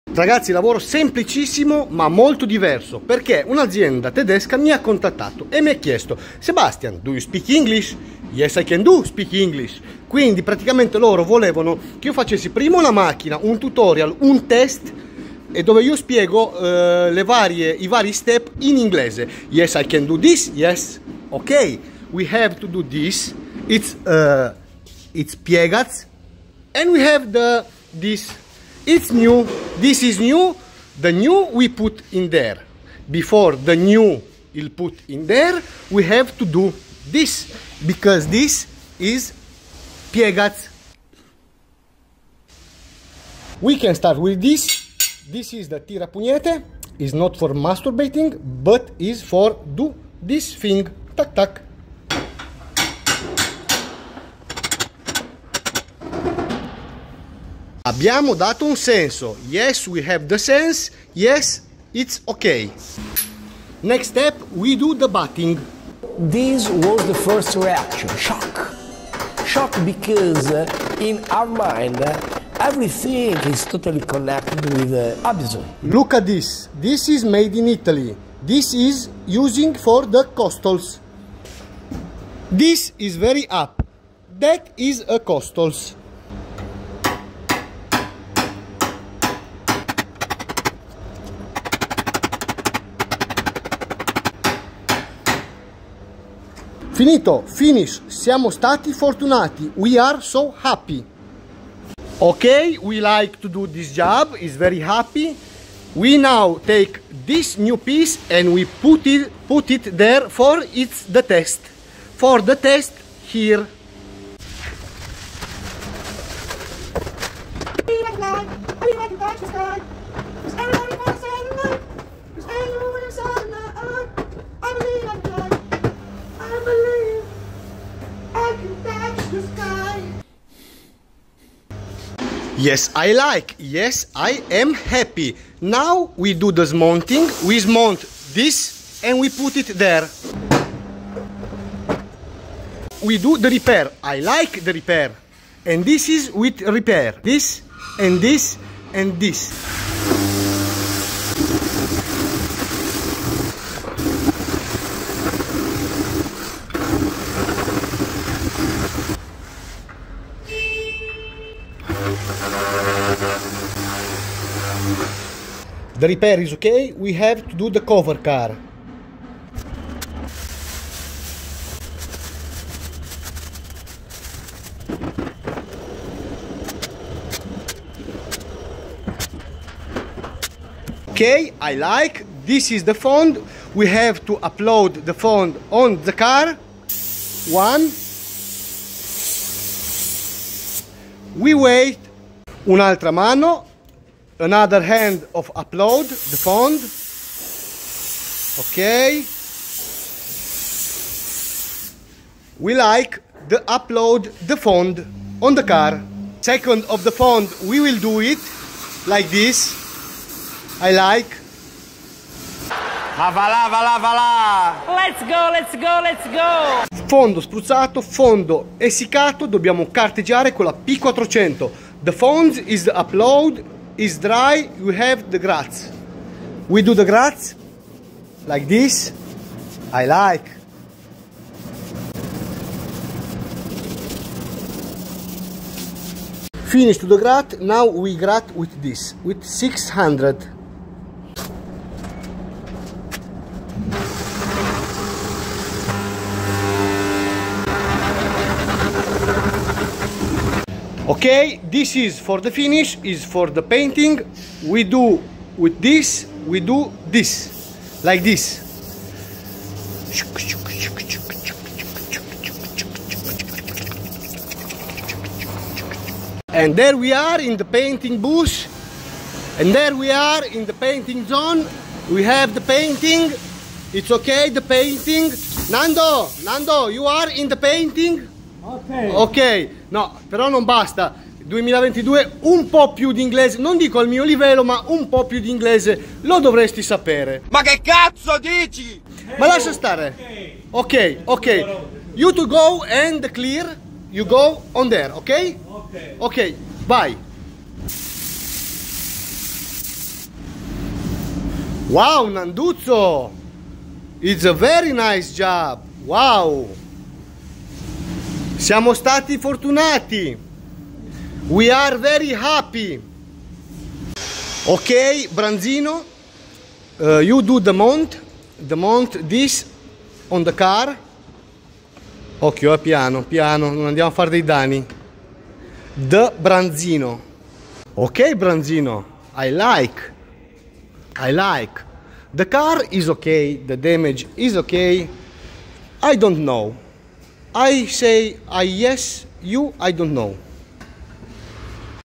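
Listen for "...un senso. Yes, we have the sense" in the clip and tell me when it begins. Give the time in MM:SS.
00:58.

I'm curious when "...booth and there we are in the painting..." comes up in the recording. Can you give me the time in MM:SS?
04:28.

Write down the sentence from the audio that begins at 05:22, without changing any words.
Occhio, eh, piano, piano, non andiamo a fare dei danni.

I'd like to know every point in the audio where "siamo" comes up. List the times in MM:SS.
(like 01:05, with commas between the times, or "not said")
01:38, 05:08.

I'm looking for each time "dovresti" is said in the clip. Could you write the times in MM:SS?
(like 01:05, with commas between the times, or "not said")
04:46.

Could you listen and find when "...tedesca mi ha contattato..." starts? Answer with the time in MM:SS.
00:04.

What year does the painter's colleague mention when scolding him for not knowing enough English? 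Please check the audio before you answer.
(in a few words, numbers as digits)
2022.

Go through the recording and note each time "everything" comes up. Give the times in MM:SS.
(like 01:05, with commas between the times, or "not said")
01:12.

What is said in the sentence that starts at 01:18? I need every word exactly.
This is using for the costals.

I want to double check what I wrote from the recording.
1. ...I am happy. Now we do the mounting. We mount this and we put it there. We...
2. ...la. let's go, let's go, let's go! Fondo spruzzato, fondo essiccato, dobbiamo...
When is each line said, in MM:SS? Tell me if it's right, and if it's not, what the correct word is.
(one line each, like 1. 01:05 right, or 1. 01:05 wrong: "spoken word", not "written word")
1. 02:14 right
2. 03:33 right.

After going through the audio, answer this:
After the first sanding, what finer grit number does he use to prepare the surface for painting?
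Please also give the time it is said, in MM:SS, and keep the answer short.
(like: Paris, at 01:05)
600, at 03:59.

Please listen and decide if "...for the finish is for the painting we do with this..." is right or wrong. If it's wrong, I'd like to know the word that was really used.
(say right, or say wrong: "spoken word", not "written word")
right.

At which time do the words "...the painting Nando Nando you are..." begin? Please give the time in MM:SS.
04:34.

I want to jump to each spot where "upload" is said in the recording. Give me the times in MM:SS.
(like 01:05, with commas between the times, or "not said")
03:04, 03:15, 03:23, 03:42.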